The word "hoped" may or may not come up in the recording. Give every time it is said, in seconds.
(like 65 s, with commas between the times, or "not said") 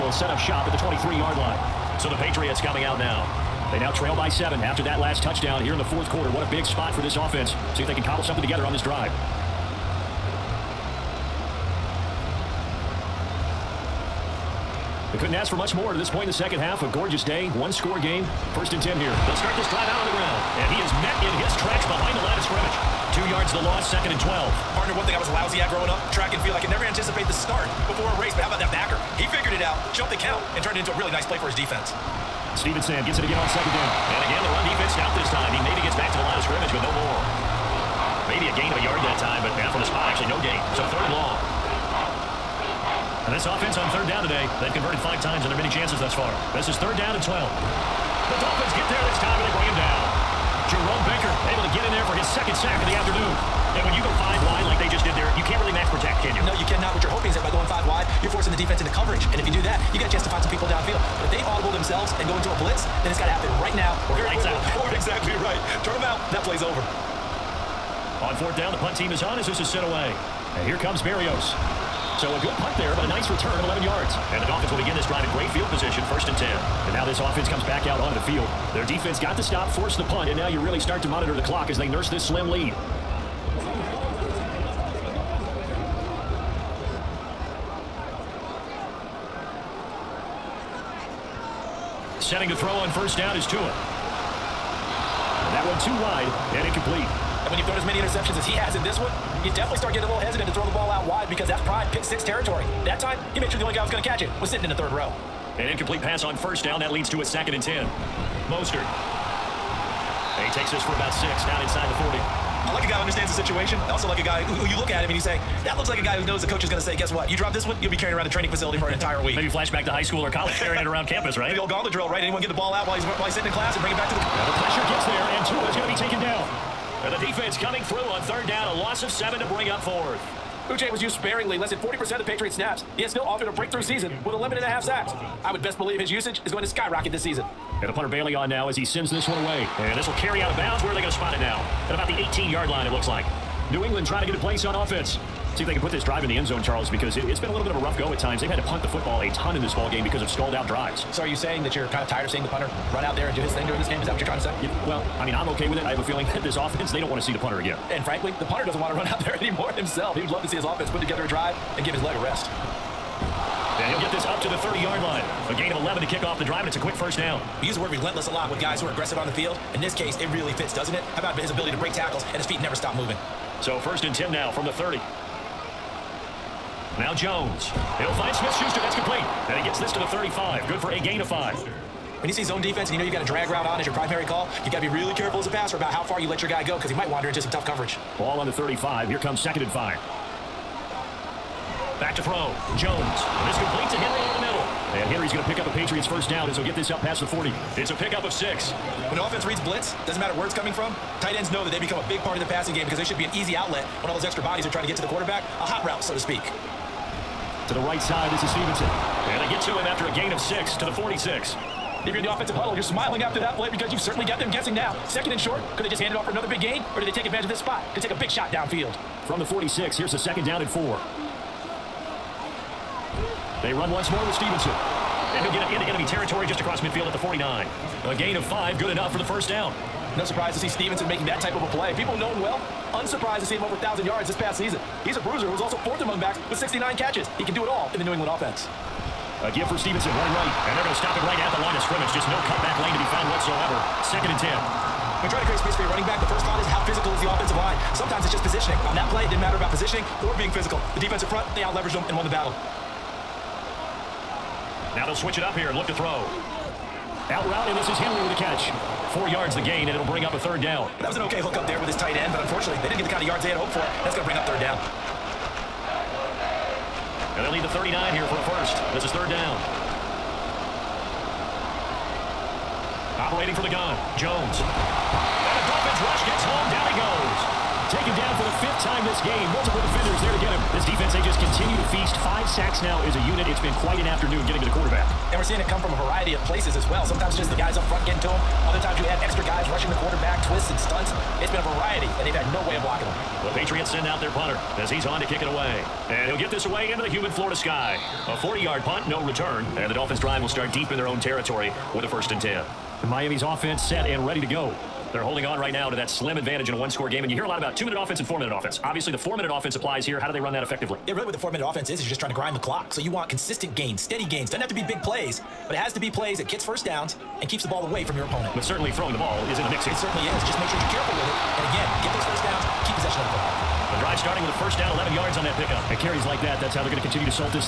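263 s.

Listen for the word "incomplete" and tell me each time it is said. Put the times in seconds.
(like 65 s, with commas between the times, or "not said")
96 s, 105 s.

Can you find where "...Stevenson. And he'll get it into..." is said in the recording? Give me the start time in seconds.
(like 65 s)
224 s.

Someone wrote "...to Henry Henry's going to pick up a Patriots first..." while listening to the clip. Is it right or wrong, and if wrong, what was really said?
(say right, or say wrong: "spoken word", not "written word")
right.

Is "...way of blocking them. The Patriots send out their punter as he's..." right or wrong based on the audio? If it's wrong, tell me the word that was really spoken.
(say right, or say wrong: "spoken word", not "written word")
right.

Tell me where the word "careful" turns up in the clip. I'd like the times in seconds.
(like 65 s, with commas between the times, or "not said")
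185 s, 320 s.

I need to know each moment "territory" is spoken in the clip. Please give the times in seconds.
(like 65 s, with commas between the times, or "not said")
102 s, 226 s, 301 s.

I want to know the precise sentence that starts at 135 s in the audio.
I would best believe his usage is going to skyrocket this season.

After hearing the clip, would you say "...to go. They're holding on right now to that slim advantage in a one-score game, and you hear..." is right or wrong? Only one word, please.
right.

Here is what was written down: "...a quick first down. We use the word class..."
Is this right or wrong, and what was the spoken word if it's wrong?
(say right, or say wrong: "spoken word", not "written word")
wrong: "relentless", not "class".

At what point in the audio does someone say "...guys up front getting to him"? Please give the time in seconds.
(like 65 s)
287 s.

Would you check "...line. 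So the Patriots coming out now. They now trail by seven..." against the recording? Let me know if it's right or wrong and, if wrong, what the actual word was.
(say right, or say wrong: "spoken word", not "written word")
right.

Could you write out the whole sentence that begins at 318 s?
But certainly throwing the ball is in the mix here.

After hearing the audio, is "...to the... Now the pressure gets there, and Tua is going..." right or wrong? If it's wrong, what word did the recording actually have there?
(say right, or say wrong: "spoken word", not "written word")
right.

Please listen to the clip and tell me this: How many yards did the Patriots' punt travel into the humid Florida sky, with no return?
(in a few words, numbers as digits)
40.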